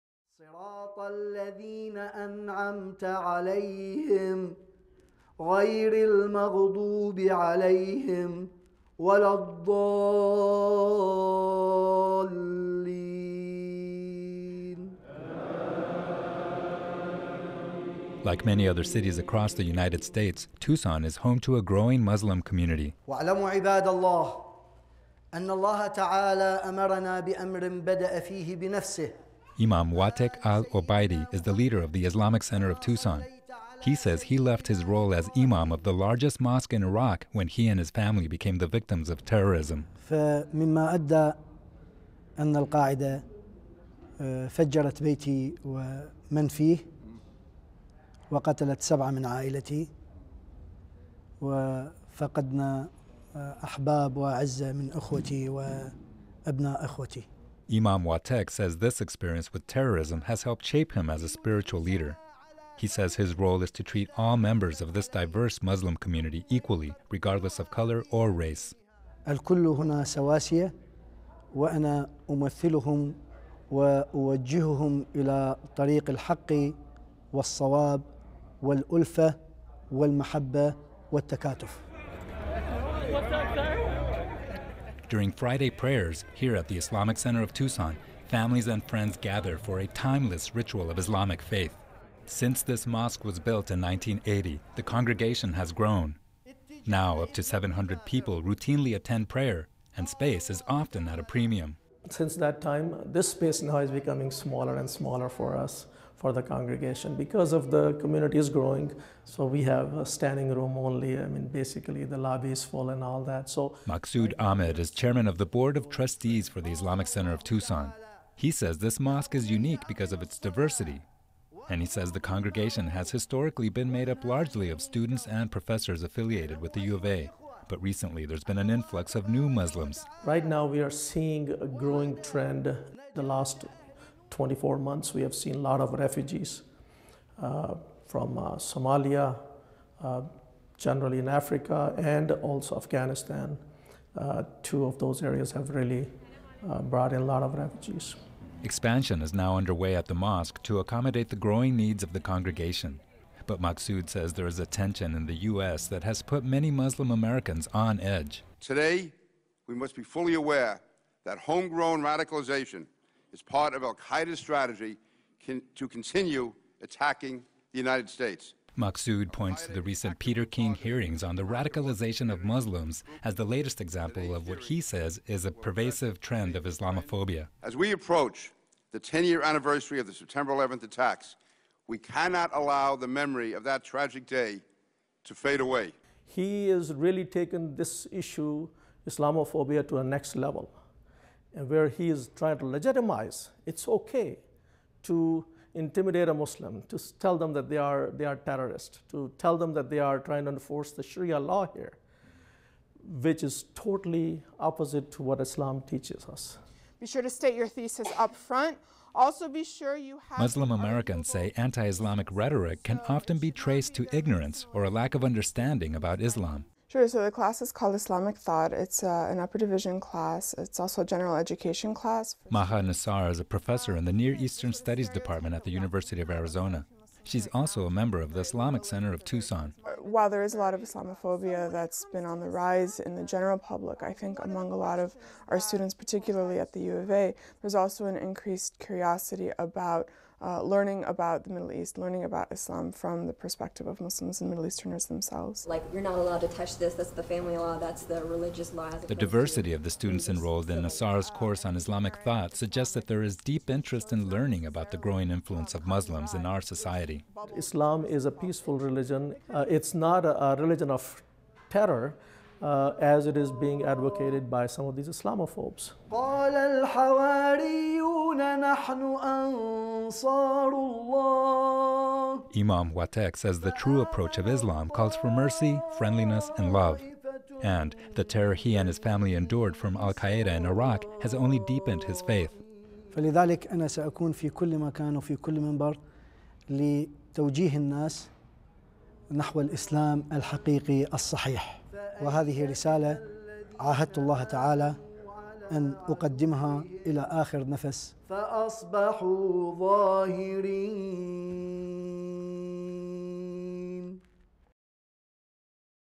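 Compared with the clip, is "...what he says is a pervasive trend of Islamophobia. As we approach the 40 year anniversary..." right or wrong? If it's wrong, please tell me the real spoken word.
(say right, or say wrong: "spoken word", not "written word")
wrong: "10", not "40".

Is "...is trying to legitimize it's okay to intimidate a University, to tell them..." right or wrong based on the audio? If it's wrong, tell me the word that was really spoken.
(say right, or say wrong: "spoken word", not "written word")
wrong: "Muslim", not "University".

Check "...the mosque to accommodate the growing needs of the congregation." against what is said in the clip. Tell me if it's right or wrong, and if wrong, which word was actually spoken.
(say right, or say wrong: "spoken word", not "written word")
right.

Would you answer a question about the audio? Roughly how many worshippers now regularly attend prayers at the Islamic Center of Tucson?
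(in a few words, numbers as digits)
700.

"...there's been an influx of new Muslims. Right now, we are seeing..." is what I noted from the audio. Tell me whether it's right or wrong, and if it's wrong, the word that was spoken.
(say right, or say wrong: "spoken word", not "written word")
right.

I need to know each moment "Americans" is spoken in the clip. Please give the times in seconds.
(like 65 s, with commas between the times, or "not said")
157 s, 210 s.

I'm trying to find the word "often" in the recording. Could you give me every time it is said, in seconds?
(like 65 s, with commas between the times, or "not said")
100 s, 213 s.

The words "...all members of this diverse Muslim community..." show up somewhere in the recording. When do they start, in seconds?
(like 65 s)
64 s.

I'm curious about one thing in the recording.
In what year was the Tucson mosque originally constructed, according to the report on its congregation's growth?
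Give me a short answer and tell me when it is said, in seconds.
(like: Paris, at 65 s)
1980, at 93 s.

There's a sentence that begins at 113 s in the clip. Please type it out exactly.
So Maksud Ahmed is chairman of the board of trustees for the Islamic Center of Tucson.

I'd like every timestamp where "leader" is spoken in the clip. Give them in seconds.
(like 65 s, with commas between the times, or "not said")
31 s, 61 s.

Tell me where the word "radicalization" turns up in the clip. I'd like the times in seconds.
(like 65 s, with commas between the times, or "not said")
162 s, 171 s.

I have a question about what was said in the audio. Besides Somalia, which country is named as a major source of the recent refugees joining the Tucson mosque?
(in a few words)
Afghanistan.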